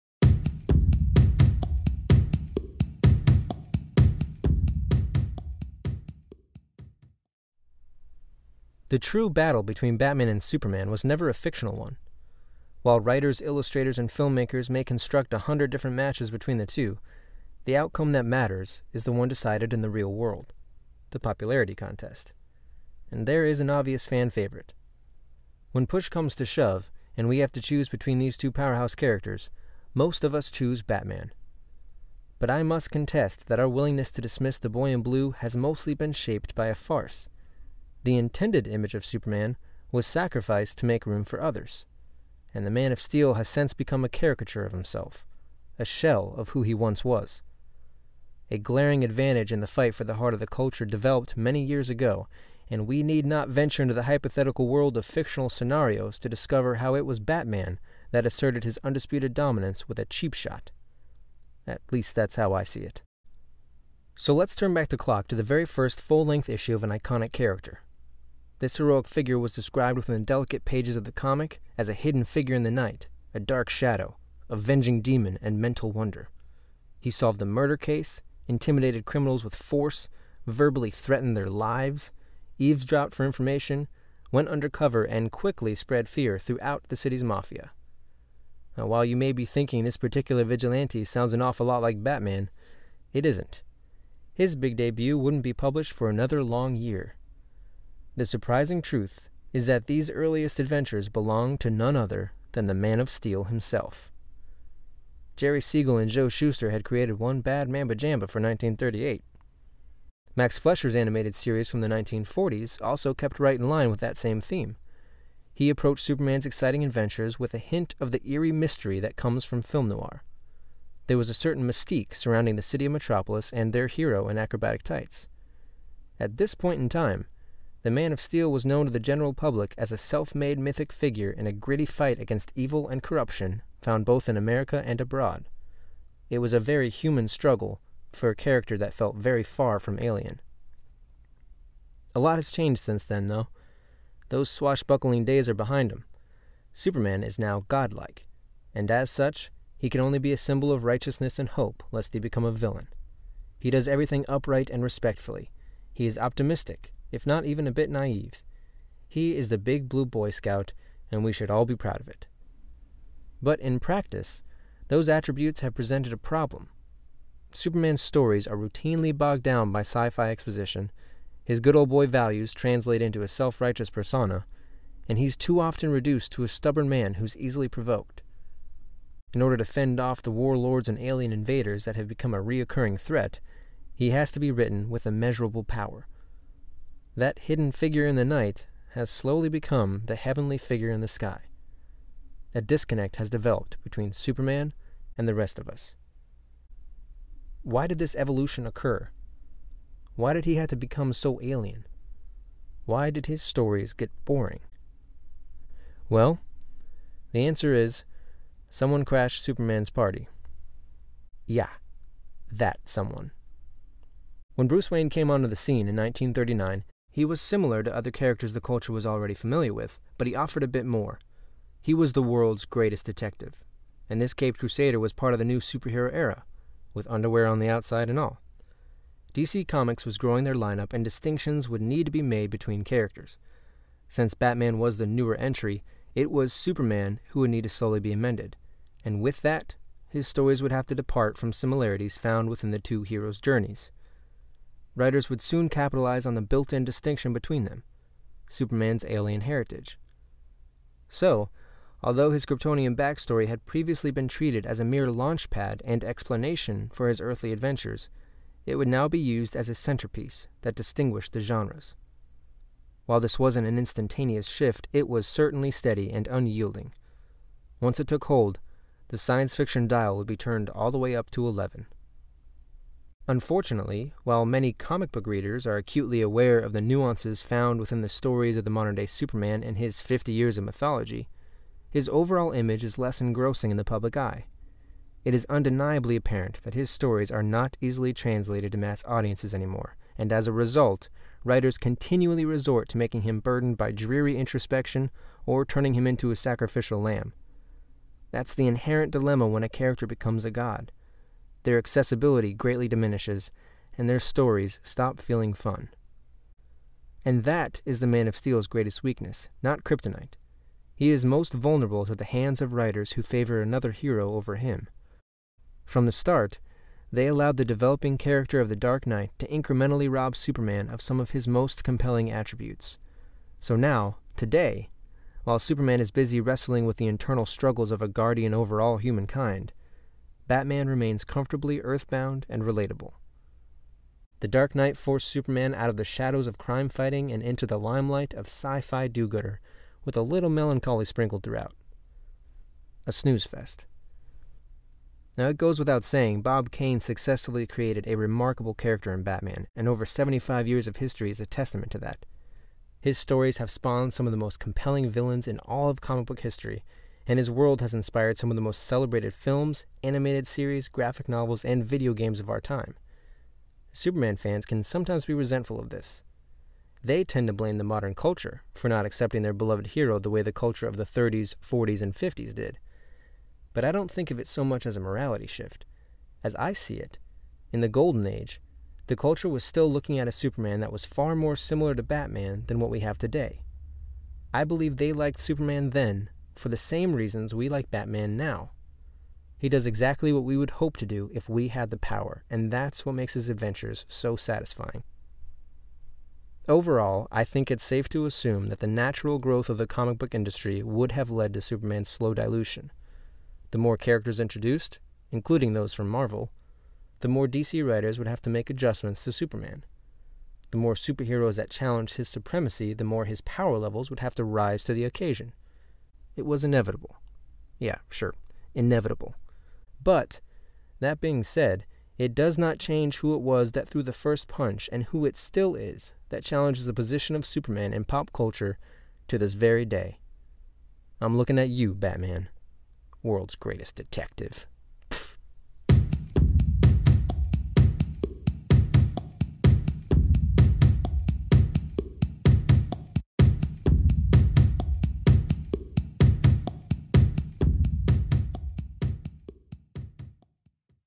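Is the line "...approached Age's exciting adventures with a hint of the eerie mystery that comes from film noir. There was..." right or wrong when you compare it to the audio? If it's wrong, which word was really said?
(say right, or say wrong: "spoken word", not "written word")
wrong: "Superman", not "Age".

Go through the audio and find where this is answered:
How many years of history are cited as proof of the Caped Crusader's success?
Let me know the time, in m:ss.
5:50.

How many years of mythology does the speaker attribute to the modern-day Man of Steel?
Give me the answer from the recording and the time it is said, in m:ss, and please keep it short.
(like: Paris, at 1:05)
50, at 4:40.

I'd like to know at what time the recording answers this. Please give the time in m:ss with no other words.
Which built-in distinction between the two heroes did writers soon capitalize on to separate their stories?
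4:08.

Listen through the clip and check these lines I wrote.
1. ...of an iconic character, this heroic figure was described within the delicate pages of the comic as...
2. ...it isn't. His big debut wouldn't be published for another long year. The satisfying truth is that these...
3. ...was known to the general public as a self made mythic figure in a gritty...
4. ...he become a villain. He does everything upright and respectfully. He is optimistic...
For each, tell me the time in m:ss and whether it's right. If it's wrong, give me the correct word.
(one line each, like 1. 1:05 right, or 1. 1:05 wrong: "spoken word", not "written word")
1. 1:06 right
2. 1:33 wrong: "surprising", not "satisfying"
3. 2:08 right
4. 2:32 right.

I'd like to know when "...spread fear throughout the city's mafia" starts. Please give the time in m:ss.
1:25.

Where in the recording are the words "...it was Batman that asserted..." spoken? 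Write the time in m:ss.
0:56.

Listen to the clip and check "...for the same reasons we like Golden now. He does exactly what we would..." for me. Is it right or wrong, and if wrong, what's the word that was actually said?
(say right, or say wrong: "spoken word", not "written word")
wrong: "Batman", not "Golden".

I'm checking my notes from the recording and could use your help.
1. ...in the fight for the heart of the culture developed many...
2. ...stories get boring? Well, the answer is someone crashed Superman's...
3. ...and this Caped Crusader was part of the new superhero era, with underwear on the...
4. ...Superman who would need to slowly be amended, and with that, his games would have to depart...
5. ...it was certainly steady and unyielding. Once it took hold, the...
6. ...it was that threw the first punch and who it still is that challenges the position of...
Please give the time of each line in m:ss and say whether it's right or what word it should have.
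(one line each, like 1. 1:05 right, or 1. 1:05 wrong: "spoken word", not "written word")
1. 0:49 right
2. 3:23 right
3. 3:44 right
4. 3:56 wrong: "stories", not "games"
5. 4:24 right
6. 7:03 right.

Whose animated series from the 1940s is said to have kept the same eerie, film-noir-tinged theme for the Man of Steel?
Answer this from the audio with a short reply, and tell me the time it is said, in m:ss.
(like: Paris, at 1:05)
Max Fleischer, at 1:50.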